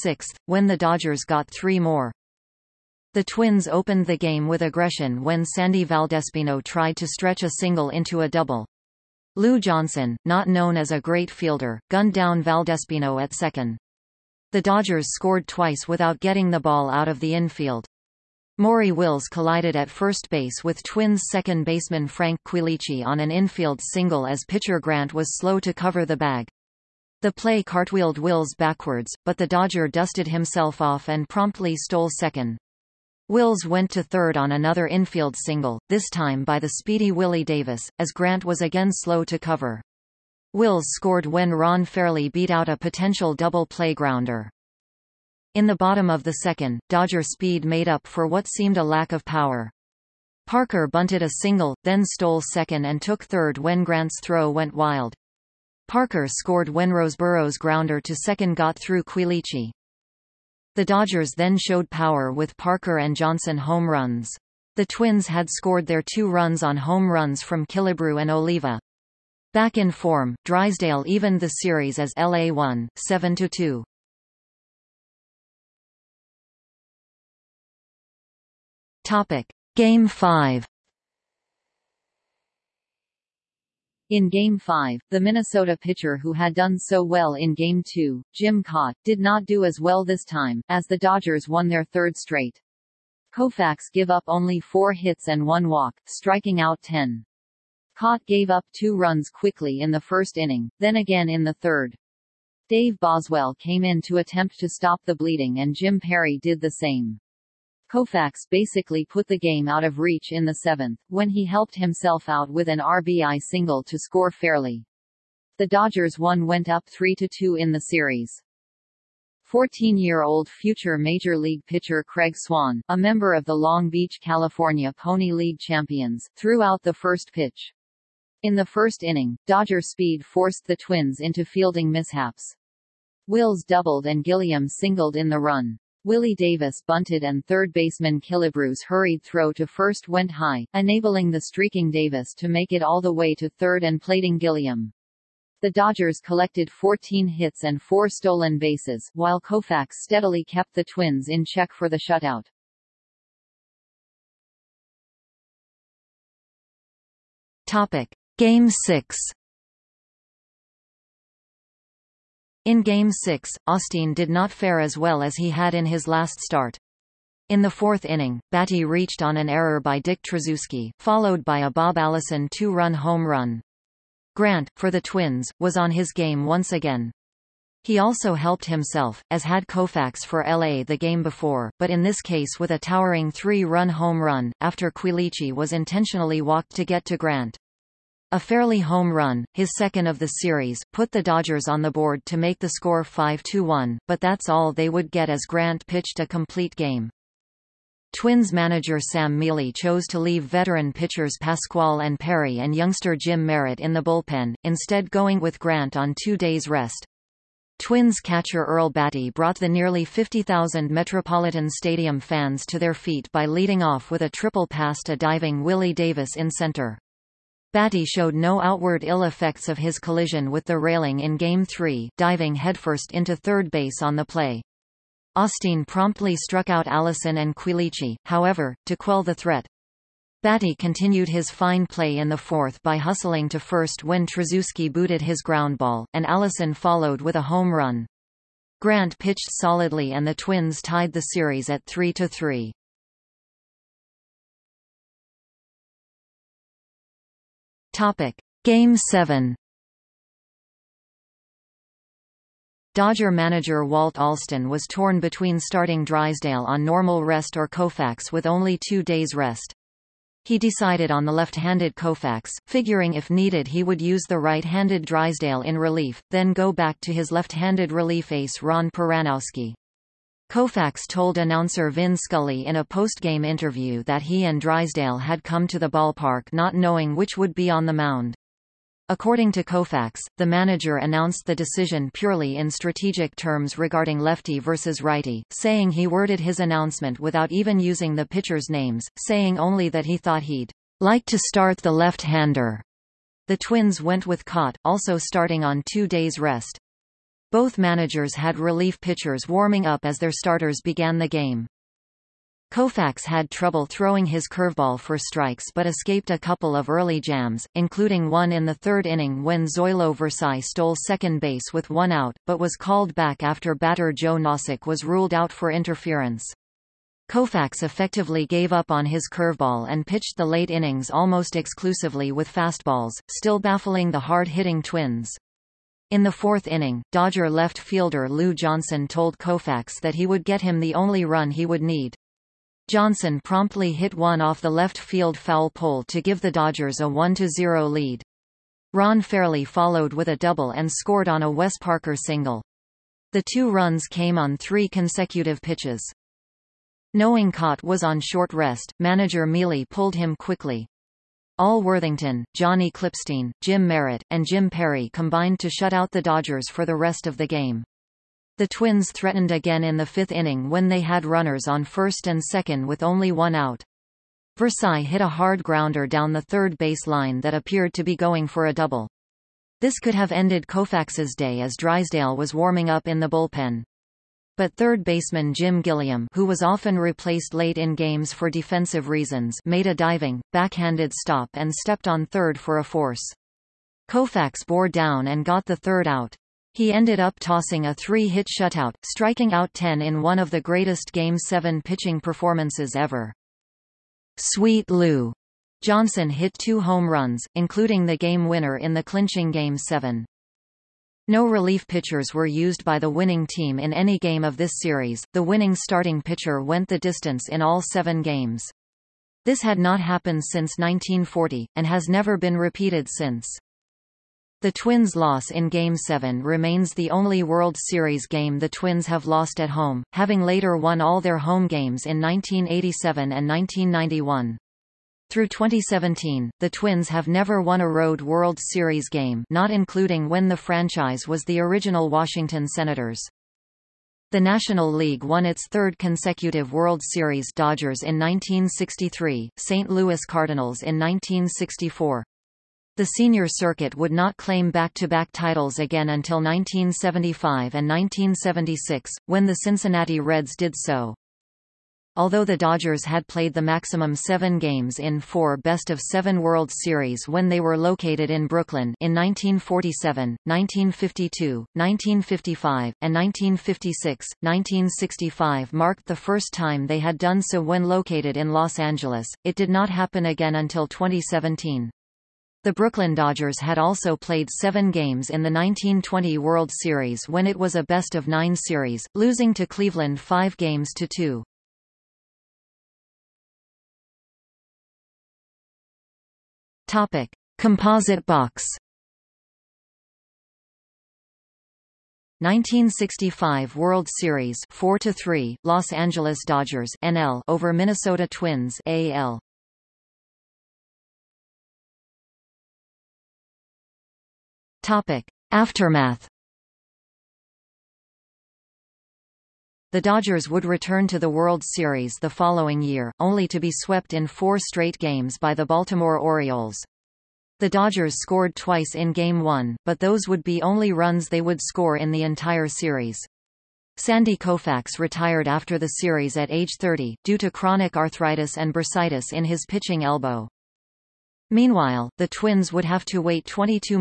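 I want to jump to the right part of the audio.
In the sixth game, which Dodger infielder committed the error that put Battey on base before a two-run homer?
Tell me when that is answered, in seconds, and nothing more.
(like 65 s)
169 s.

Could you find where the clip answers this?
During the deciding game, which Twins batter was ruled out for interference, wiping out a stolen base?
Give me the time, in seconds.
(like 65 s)
314 s.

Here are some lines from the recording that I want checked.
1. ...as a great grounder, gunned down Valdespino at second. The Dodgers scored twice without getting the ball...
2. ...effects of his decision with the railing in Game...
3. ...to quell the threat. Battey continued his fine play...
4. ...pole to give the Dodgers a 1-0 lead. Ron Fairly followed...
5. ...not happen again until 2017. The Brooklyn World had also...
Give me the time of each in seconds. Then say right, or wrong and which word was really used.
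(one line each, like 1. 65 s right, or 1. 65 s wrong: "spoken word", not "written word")
1. 10 s wrong: "fielder", not "grounder"
2. 219 s wrong: "collision", not "decision"
3. 228 s right
4. 335 s right
5. 469 s wrong: "Dodgers", not "World".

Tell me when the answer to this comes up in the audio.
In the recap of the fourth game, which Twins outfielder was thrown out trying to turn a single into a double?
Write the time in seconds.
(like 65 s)
5 s.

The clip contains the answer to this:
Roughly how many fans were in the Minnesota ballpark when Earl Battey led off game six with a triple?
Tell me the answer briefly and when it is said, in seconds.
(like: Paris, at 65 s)
50,000, at 210 s.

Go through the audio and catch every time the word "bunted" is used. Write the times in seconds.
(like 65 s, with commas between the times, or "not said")
50 s, 136 s.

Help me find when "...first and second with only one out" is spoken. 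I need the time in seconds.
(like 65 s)
361 s.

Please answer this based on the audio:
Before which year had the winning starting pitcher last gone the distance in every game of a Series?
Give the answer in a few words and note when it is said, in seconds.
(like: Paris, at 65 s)
1940, at 410 s.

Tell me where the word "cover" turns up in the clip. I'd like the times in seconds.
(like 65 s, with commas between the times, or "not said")
25 s, 39 s.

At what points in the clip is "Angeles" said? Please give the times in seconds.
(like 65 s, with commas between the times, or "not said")
468 s, 495 s.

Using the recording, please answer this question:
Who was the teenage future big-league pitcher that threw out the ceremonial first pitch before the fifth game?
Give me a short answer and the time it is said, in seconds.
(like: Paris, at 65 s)
Craig Swan, at 122 s.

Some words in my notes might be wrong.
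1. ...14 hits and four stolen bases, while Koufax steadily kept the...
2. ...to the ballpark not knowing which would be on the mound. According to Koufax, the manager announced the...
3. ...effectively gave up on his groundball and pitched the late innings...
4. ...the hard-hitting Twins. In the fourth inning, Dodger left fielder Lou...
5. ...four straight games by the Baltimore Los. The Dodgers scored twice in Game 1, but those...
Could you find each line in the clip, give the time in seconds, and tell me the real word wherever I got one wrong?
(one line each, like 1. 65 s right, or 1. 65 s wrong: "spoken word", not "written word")
1. 146 s right
2. 275 s right
3. 317 s wrong: "curveball", not "groundball"
4. 324 s right
5. 514 s wrong: "Orioles", not "Los".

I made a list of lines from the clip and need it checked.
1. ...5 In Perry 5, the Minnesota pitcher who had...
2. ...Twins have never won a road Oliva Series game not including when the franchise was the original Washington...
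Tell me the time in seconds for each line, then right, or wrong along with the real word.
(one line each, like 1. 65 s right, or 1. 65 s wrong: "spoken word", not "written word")
1. 80 s wrong: "Game", not "Perry"
2. 426 s wrong: "World", not "Oliva".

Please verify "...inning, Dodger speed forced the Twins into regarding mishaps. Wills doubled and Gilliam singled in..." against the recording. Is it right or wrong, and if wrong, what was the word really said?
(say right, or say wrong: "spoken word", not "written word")
wrong: "fielding", not "regarding".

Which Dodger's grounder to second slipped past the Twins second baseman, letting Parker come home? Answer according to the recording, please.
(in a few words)
Roseboro.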